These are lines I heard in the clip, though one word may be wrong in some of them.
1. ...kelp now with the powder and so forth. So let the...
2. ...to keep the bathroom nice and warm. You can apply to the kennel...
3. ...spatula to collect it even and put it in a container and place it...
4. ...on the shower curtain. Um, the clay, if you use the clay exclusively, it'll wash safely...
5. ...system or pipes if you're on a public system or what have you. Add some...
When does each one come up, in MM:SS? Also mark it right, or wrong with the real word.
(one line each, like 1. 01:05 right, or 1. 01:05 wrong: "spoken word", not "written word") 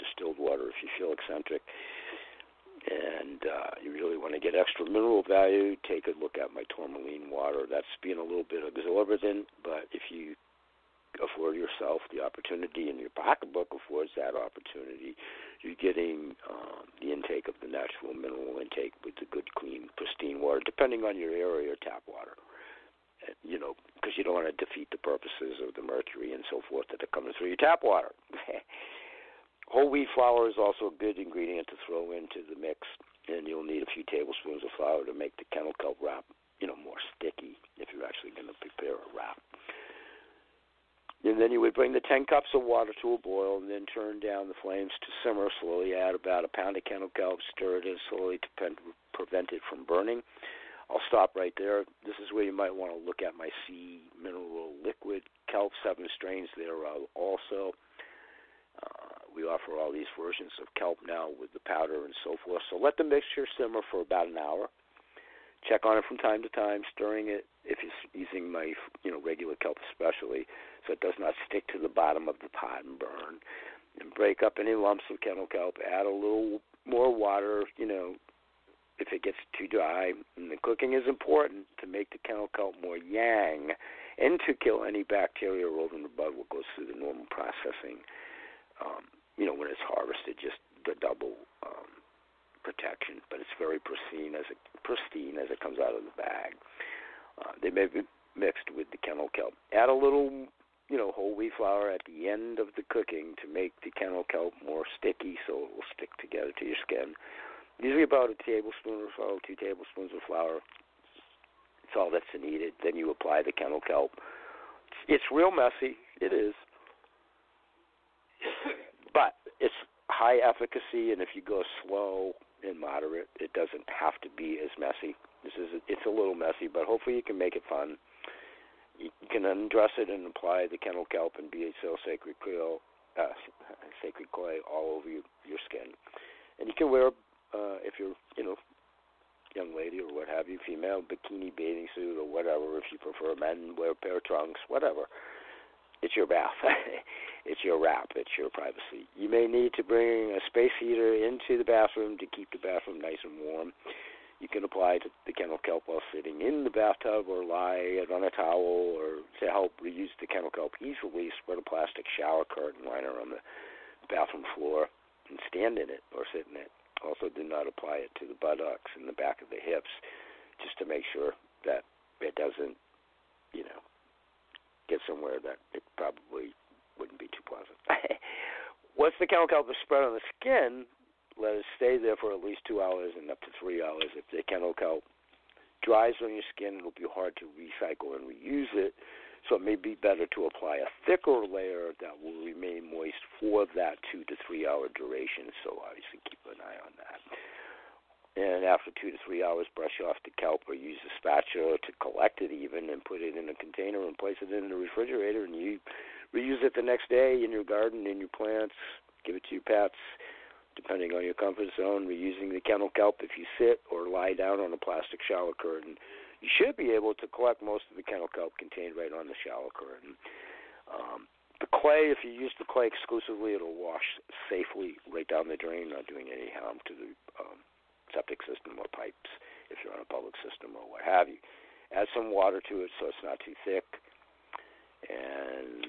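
1. 01:00 right
2. 02:32 right
3. 03:21 right
4. 03:39 right
5. 03:48 right.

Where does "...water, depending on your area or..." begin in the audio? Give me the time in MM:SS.
00:20.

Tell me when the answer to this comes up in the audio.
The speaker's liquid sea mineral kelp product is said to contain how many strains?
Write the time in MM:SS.
00:55.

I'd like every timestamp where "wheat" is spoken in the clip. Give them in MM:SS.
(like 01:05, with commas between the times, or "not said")
00:29, 01:41.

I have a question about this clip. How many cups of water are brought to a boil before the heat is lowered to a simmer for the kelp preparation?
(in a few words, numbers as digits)
10.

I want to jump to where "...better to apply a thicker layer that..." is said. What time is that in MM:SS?
03:09.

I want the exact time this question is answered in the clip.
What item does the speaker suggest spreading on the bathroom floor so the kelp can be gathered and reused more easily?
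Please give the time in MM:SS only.
02:41.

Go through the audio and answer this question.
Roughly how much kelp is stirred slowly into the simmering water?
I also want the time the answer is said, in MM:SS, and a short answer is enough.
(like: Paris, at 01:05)
A pound, at 00:46.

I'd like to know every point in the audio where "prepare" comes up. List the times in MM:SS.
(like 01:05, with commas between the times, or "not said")
00:38.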